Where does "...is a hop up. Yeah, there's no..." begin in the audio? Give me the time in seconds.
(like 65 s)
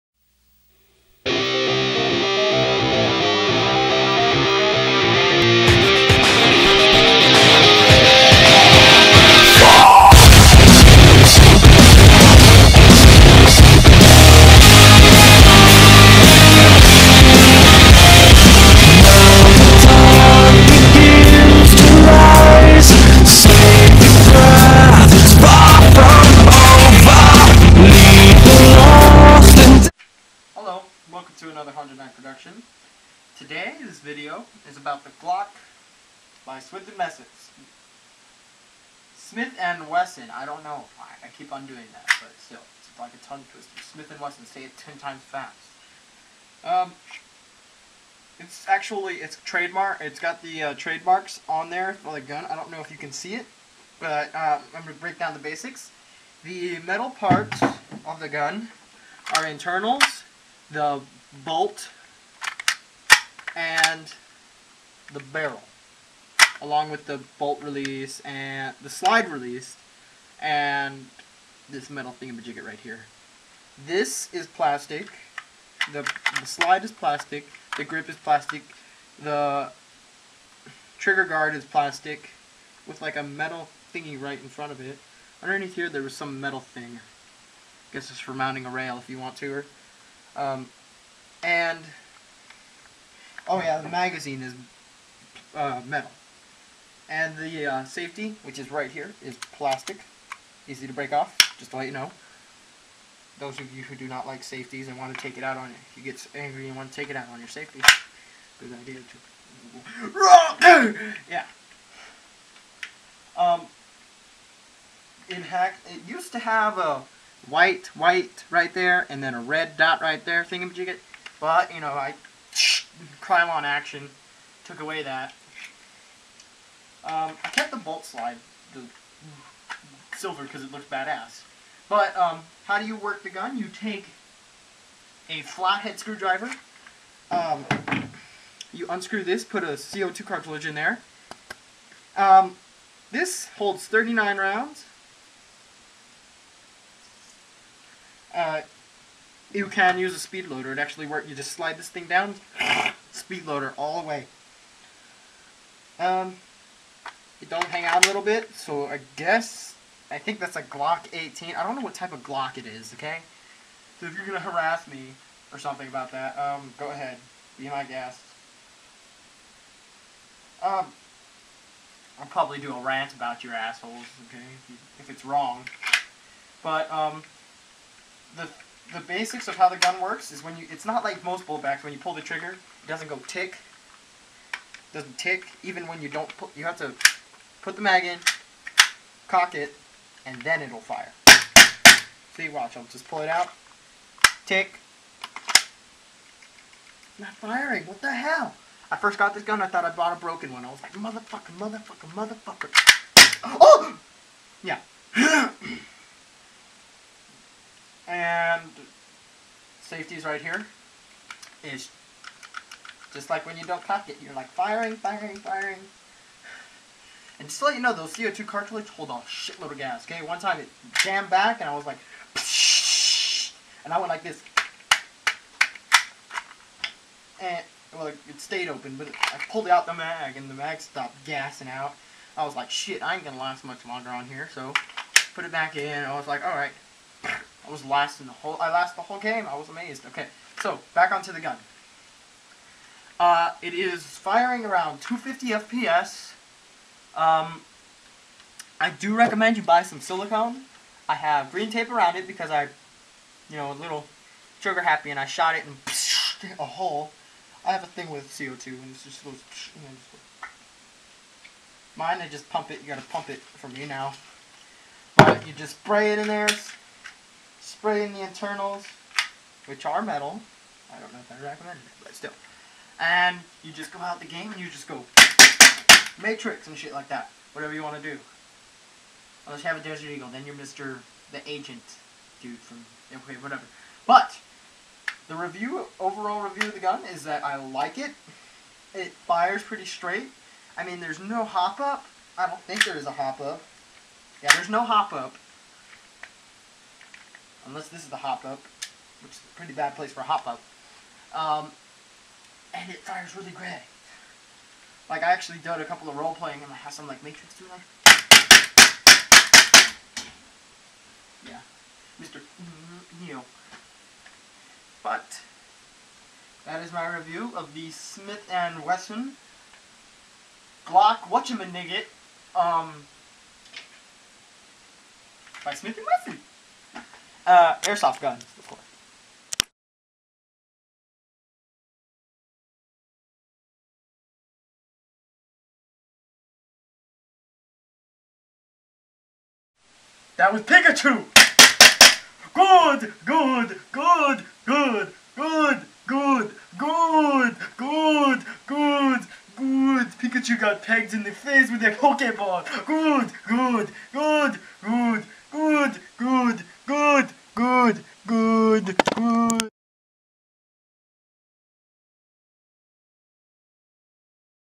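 292 s.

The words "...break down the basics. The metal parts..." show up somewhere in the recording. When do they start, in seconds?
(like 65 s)
55 s.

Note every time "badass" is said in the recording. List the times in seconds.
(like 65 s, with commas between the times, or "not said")
130 s.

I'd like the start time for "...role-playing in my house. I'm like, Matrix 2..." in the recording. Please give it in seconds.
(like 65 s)
306 s.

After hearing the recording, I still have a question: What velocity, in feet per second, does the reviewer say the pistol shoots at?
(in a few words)
250 FPS.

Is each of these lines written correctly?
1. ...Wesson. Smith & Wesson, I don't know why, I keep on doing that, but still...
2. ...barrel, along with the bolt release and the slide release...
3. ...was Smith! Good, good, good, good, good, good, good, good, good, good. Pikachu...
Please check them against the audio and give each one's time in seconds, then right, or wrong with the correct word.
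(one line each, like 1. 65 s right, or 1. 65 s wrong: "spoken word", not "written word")
1. 36 s right
2. 65 s right
3. 340 s wrong: "Pikachu", not "Smith".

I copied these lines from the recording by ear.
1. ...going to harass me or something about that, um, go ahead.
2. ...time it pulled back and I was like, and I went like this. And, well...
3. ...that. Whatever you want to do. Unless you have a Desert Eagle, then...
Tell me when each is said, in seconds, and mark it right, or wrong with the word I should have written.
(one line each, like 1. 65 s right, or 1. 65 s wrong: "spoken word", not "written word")
1. 164 s right
2. 220 s wrong: "jammed", not "pulled"
3. 277 s right.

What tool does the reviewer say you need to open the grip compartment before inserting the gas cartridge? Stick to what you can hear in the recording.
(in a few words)
flathead screwdriver.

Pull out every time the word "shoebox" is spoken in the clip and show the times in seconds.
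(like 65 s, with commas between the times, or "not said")
not said.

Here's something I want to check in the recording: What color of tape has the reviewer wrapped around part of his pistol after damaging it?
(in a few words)
green.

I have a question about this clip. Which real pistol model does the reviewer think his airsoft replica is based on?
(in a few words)
Glock 18.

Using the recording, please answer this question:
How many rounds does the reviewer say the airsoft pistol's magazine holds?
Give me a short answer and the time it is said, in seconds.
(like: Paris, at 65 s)
39, at 143 s.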